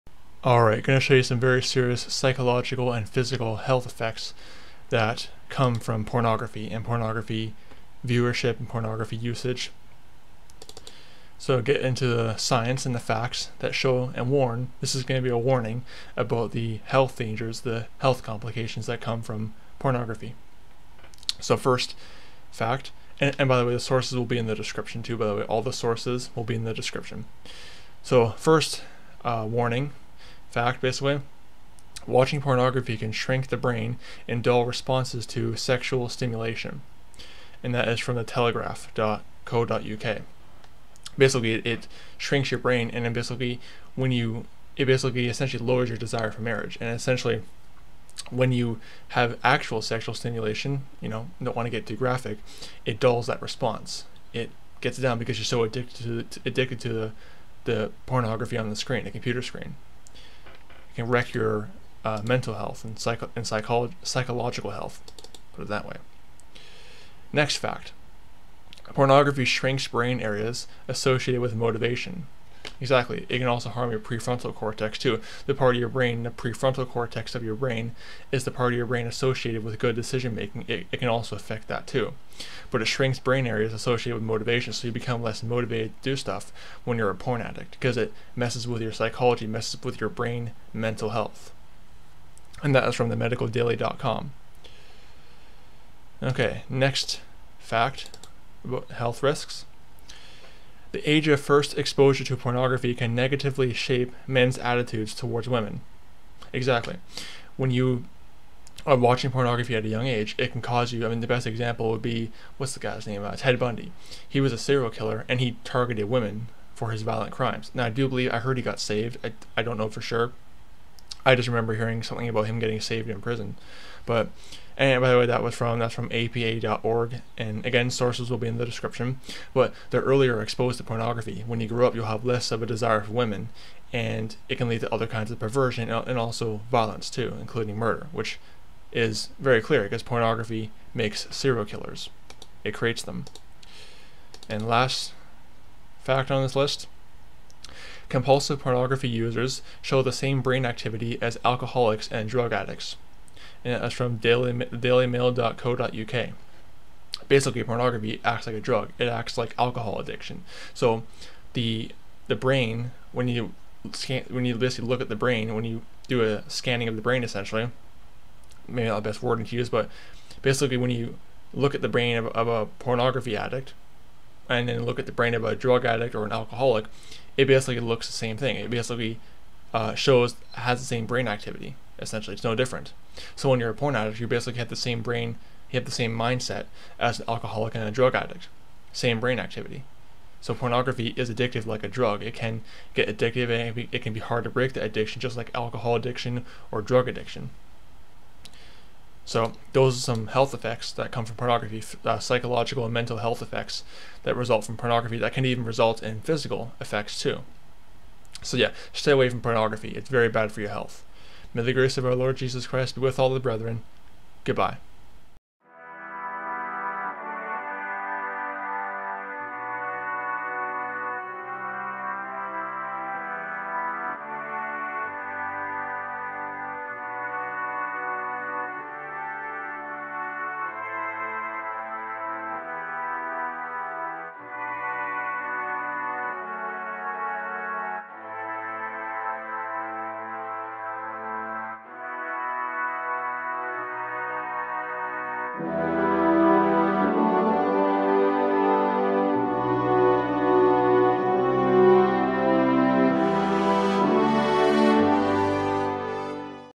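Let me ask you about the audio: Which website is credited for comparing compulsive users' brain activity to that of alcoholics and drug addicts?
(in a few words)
dailymail.co.uk.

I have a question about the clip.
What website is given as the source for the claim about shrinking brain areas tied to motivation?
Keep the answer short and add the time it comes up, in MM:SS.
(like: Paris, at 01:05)
themedicaldaily.com, at 01:33.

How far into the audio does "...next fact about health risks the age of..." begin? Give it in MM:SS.
01:36.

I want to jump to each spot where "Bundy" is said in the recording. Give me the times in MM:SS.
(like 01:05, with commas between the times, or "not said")
01:53.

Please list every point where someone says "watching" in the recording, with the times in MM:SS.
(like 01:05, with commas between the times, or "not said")
00:32, 01:48.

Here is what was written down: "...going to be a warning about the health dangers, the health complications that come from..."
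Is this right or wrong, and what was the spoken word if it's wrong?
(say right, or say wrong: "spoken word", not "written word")
right.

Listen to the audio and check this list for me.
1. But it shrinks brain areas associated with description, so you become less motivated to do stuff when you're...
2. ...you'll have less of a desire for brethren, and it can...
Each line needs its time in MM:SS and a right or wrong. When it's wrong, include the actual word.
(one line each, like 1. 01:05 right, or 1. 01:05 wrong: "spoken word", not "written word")
1. 01:22 wrong: "motivation", not "description"
2. 02:11 wrong: "women", not "brethren".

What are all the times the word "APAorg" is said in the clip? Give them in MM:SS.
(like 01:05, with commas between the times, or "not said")
02:06.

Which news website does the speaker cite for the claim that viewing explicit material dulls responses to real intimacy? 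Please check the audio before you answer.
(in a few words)
telegraph.co.uk.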